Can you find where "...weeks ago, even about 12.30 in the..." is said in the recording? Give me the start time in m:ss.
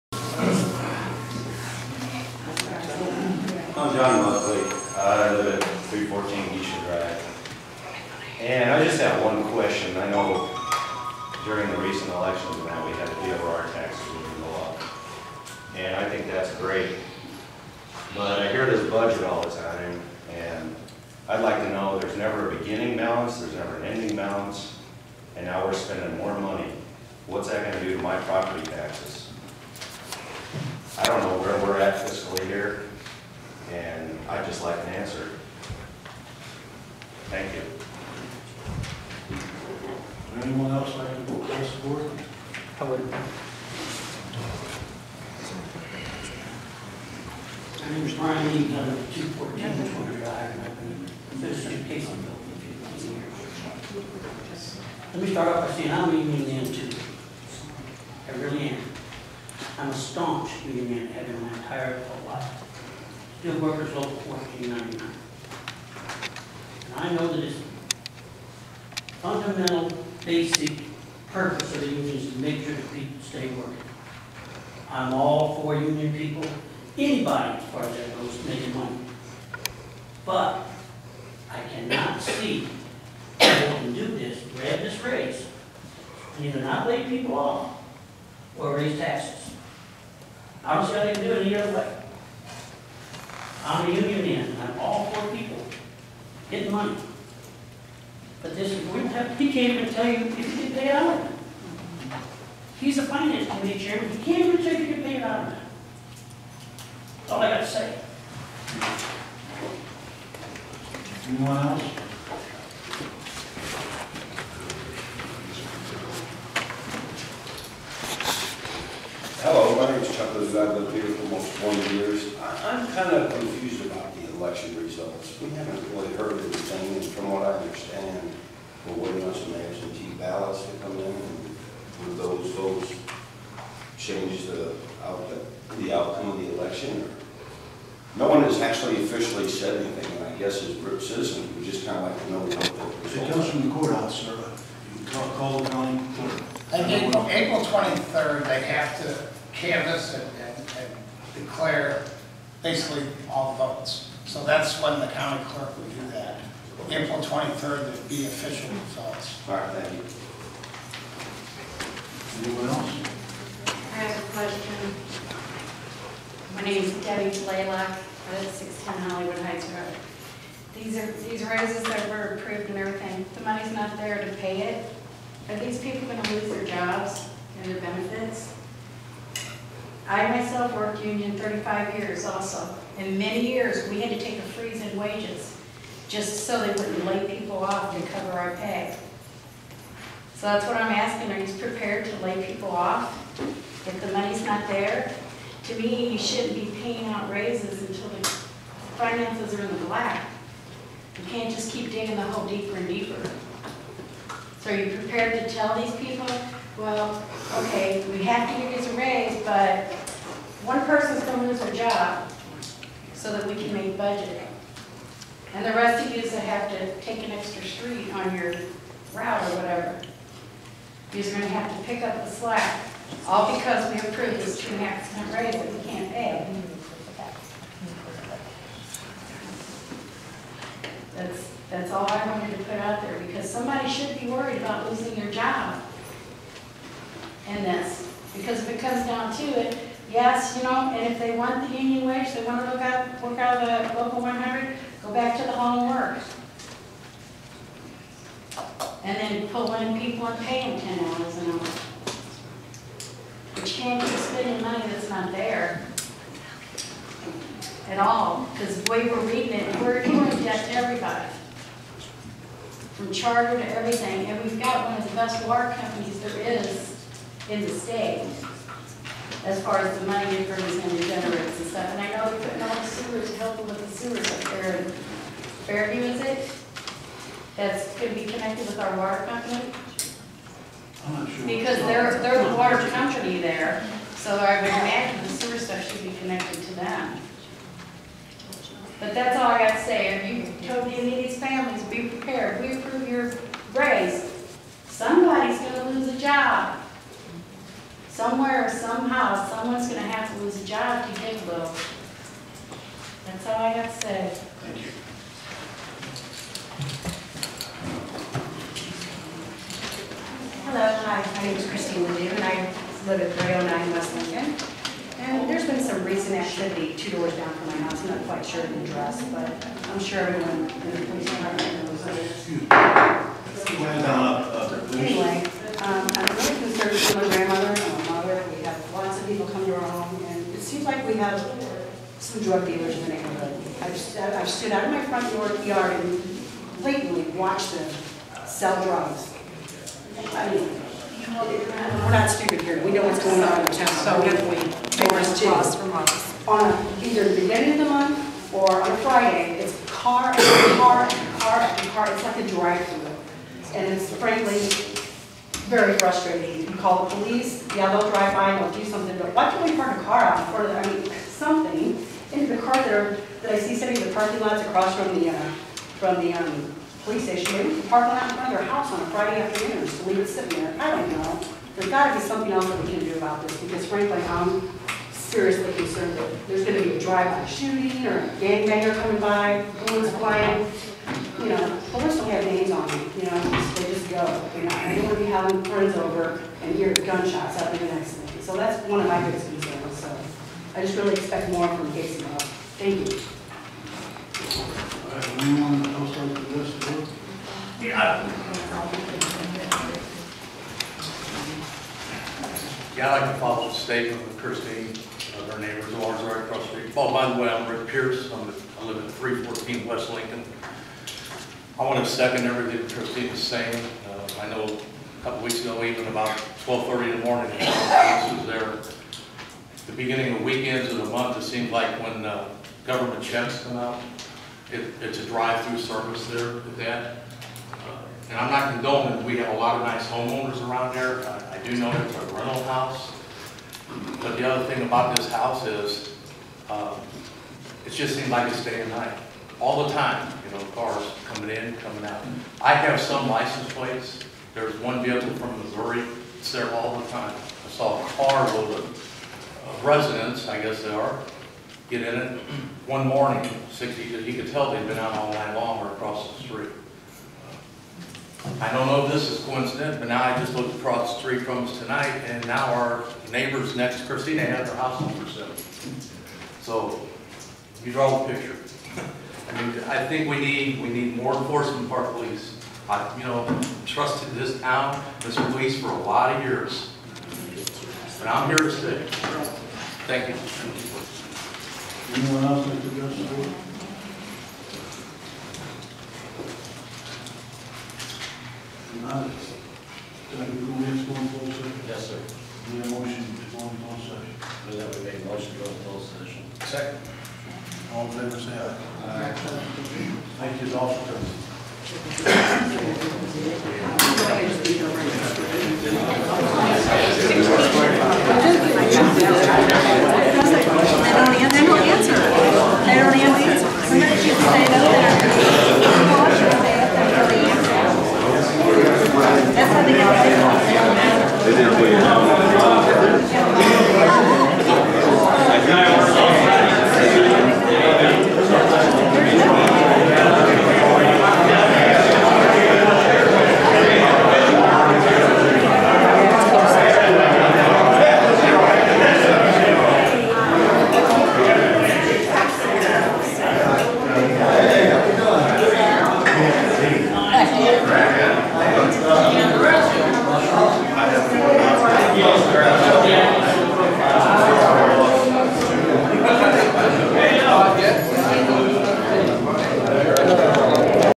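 6:55.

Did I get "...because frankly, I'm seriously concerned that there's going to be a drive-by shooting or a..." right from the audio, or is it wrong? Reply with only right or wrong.
right.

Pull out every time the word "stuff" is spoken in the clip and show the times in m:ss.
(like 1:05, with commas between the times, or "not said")
4:31, 4:45.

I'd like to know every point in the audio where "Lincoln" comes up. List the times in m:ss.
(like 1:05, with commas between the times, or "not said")
5:14, 6:50.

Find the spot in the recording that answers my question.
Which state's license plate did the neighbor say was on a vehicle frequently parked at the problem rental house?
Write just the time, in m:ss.
7:25.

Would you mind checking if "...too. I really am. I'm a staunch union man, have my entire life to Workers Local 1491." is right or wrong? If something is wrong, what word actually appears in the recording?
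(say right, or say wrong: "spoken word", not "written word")
wrong: "1499", not "1491".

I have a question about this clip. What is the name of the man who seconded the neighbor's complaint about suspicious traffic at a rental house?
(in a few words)
Rick Pierce.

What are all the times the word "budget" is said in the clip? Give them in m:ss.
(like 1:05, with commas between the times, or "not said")
0:18, 3:33.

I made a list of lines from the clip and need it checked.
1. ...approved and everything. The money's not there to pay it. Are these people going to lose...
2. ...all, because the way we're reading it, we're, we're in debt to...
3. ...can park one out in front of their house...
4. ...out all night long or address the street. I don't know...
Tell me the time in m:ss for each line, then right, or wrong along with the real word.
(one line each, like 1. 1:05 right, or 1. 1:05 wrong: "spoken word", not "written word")
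1. 2:52 right
2. 4:17 right
3. 6:07 right
4. 7:34 wrong: "across", not "address".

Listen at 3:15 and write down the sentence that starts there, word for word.
To me, you shouldn't be paying out raises until the finances are in the black.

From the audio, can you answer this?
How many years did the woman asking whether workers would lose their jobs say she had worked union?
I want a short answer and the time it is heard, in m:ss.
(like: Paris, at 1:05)
35, at 3:01.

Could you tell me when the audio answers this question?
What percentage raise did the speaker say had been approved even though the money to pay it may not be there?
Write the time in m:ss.
3:44.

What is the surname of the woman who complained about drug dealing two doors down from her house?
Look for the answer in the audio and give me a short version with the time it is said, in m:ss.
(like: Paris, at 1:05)
Ledoux, at 5:12.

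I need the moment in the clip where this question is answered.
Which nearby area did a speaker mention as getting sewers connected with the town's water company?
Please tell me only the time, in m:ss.
4:35.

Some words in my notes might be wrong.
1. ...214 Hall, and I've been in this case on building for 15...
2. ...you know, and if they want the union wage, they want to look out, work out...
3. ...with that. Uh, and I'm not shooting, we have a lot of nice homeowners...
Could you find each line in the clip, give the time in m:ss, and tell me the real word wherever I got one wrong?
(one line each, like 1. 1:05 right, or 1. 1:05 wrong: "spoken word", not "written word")
1. 0:49 wrong: "Drive", not "Hall"
2. 4:00 right
3. 7:06 wrong: "condoning", not "shooting".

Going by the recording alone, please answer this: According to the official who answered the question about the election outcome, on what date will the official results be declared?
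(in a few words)
April 23rd.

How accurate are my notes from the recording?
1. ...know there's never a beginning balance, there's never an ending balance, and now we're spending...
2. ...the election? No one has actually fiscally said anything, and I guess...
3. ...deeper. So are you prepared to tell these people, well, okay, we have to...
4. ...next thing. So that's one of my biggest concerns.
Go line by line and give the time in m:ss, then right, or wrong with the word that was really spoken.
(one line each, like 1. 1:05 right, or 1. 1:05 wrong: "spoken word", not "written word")
1. 0:21 right
2. 2:16 wrong: "officially", not "fiscally"
3. 3:22 right
4. 6:27 right.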